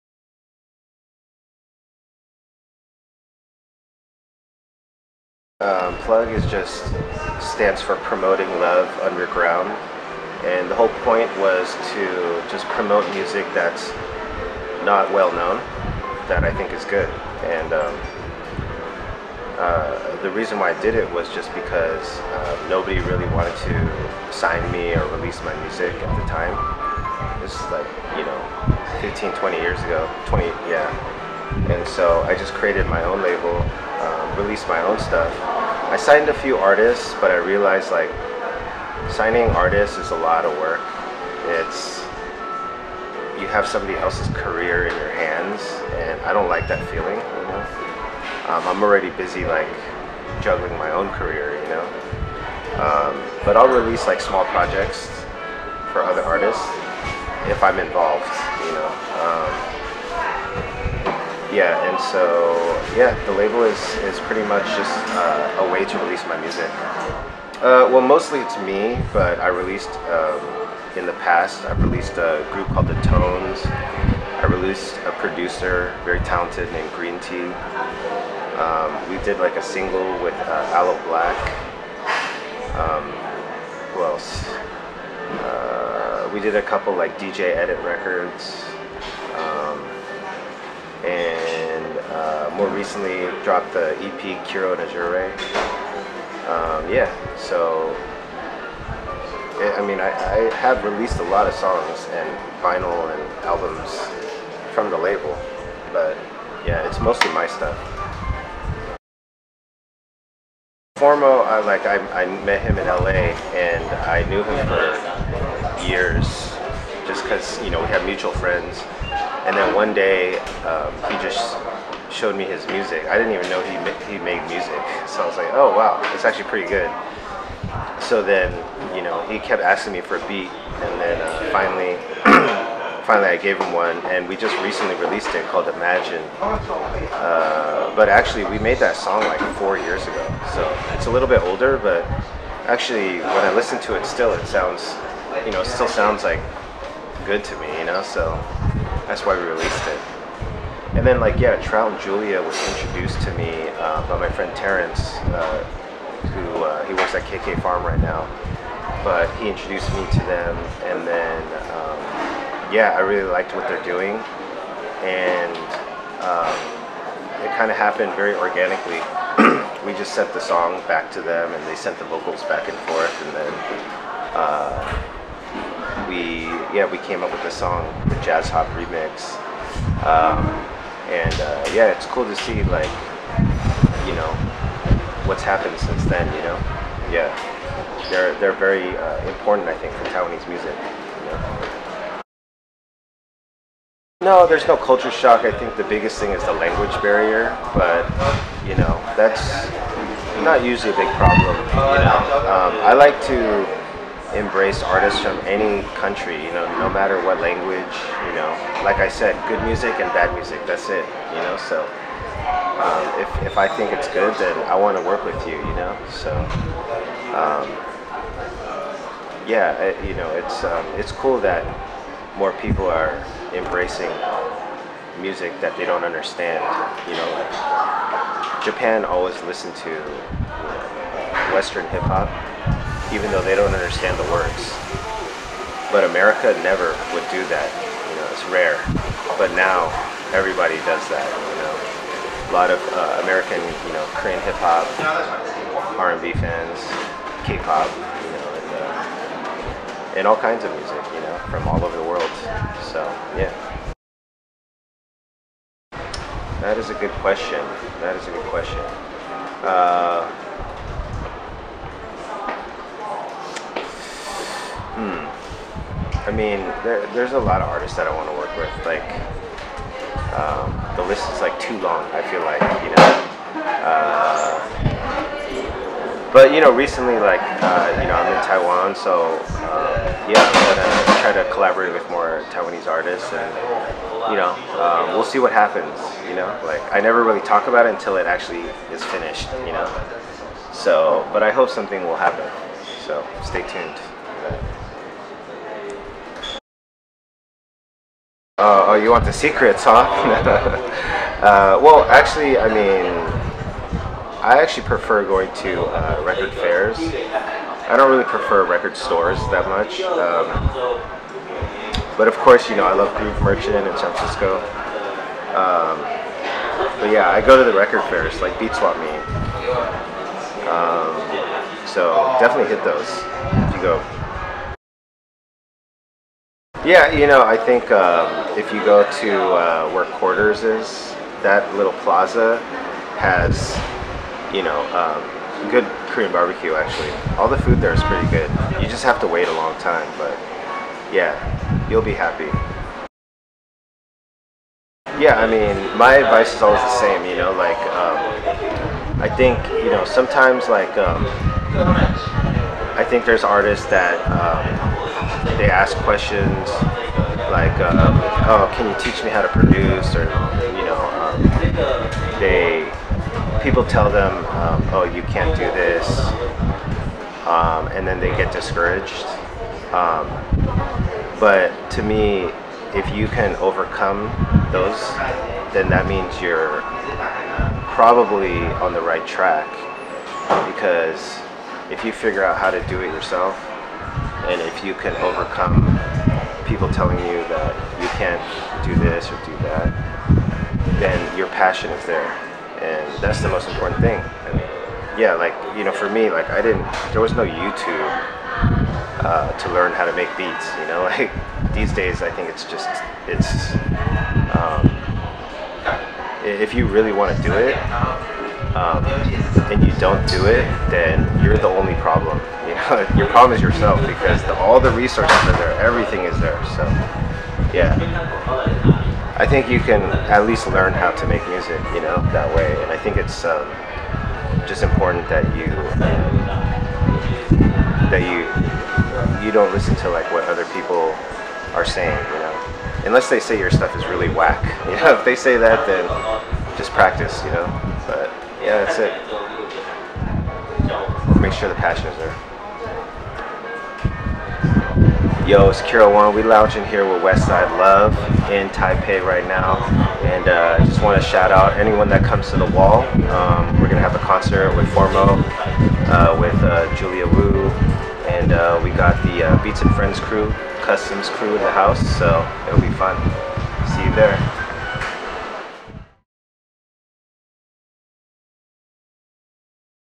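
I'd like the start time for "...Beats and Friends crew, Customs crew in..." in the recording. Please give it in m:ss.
7:39.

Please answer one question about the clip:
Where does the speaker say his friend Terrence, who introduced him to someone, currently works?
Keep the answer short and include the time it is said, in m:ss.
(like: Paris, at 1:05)
KK Farm, at 2:37.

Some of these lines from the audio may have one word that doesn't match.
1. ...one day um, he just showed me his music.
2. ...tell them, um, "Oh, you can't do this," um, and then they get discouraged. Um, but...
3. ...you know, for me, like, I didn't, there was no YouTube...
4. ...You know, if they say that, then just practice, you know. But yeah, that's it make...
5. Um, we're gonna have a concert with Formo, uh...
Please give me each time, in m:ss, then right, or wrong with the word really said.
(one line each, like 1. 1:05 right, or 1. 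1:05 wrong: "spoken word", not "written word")
1. 1:59 right
2. 6:03 right
3. 6:35 right
4. 7:14 right
5. 7:33 right.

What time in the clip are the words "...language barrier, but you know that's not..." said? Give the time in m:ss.
3:16.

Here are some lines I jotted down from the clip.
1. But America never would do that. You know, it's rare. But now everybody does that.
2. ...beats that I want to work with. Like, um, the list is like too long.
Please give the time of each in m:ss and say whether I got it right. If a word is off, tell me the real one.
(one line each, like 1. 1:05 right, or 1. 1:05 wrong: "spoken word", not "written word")
1. 3:55 right
2. 4:27 wrong: "artists", not "beats".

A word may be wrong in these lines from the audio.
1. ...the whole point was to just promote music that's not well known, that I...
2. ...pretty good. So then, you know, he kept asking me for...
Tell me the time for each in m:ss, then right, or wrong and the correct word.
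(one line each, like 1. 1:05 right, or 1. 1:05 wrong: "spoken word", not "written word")
1. 0:10 right
2. 2:06 right.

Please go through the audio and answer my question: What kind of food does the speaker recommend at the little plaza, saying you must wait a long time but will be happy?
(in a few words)
Korean barbecue.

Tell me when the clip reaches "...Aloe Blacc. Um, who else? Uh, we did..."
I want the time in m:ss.
1:20.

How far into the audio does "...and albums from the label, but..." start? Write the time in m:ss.
1:43.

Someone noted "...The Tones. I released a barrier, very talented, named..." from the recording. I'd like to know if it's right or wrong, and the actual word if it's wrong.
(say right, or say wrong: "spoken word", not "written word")
wrong: "producer", not "barrier".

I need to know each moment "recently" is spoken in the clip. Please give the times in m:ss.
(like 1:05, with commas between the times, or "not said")
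1:32, 2:14, 4:36.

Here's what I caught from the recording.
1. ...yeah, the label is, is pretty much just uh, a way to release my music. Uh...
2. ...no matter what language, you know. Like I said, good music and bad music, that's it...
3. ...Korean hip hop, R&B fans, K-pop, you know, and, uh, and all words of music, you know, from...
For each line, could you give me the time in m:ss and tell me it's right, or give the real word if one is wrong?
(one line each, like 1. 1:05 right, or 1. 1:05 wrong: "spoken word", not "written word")
1. 1:02 right
2. 3:26 right
3. 4:04 wrong: "kinds", not "words".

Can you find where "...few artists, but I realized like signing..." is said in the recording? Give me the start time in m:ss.
0:36.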